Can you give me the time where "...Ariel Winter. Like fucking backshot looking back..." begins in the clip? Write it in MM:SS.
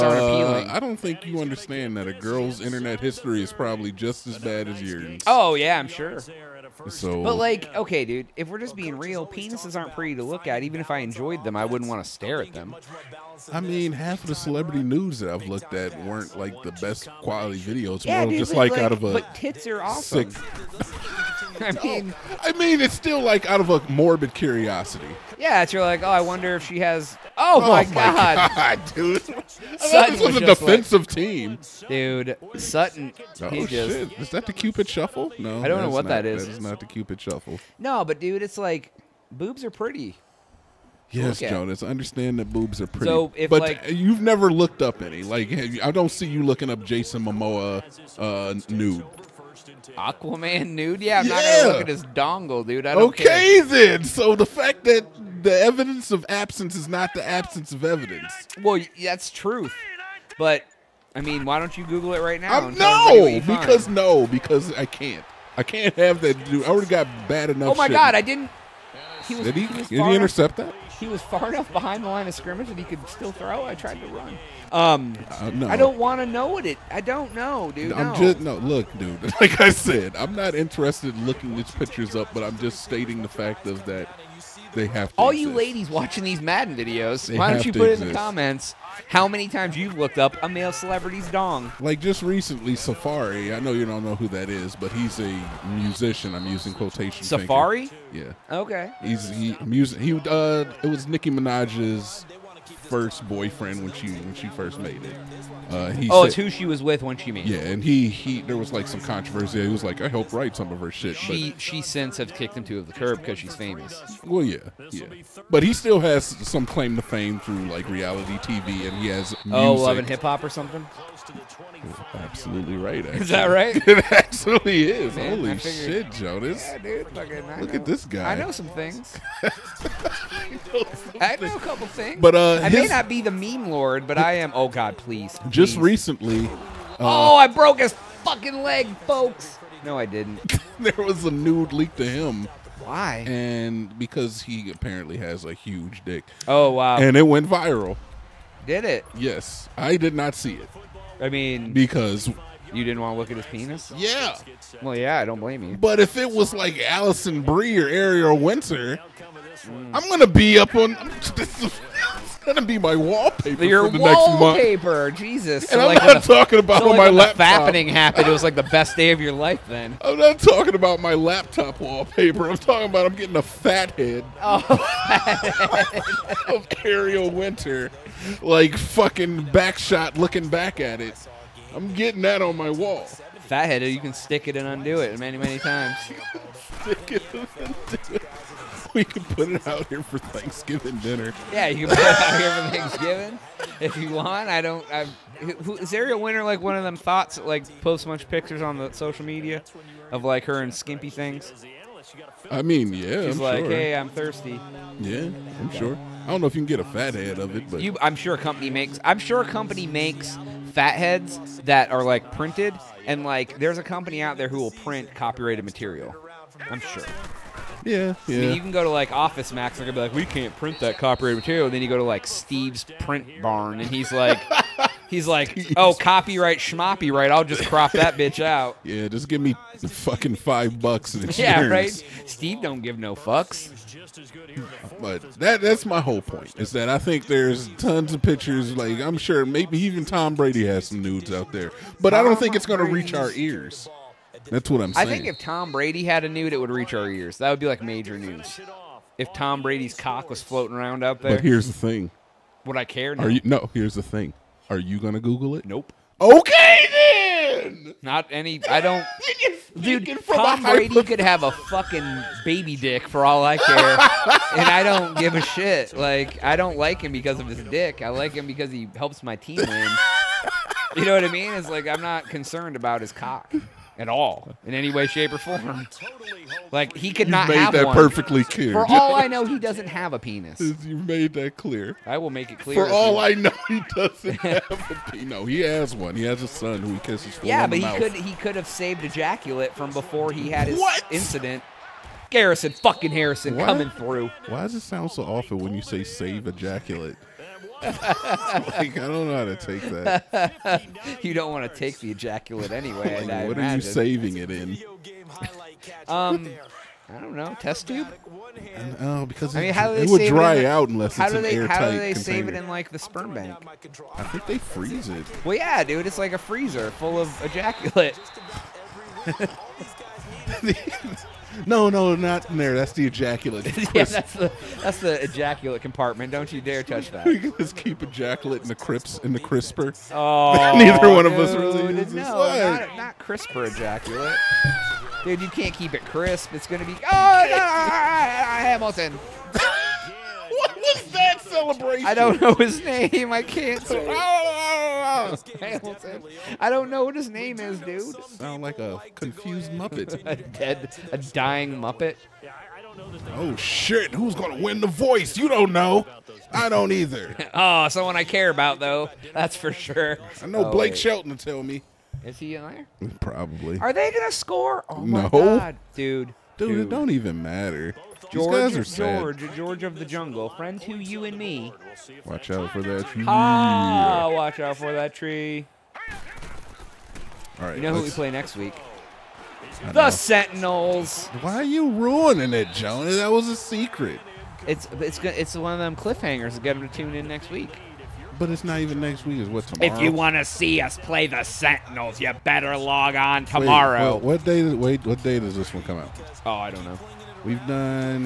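02:56.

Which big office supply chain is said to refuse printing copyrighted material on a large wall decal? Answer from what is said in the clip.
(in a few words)
Office Max.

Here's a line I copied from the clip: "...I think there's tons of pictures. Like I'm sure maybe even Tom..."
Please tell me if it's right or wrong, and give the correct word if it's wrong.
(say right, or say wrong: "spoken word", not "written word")
right.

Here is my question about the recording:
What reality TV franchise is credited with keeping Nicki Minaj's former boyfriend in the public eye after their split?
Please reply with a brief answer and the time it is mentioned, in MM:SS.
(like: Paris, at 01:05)
Love and Hip Hop, at 01:59.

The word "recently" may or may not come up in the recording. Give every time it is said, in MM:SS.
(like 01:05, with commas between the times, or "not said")
01:32, 02:15.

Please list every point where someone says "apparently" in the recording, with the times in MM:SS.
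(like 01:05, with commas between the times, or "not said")
02:24.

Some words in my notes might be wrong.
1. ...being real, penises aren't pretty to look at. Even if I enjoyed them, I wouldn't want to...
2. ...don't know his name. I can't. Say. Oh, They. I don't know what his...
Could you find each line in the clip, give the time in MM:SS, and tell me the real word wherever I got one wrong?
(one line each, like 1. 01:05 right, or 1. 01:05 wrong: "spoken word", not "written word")
1. 00:08 right
2. 05:42 wrong: "Hamilton", not "They".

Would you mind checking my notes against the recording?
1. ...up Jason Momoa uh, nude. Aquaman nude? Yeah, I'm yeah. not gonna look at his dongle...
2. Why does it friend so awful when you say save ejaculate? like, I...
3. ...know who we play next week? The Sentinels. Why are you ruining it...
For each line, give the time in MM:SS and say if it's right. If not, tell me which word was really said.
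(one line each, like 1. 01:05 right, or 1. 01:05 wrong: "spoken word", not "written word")
1. 00:46 right
2. 04:54 wrong: "sound", not "friend"
3. 06:17 right.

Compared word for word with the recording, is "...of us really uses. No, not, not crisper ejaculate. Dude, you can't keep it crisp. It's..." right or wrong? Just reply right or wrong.
right.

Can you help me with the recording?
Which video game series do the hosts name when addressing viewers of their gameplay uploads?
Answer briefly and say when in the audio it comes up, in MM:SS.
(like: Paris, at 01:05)
Madden, at 01:26.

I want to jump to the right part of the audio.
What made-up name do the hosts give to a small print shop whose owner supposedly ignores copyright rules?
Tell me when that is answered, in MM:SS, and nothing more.
03:42.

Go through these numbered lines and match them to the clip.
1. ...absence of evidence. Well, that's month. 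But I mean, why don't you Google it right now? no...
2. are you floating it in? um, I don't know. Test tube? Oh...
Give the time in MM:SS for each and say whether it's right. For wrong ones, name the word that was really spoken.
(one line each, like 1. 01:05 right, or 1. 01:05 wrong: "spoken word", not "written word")
1. 00:57 wrong: "truth", not "month"
2. 05:03 wrong: "saving", not "floating".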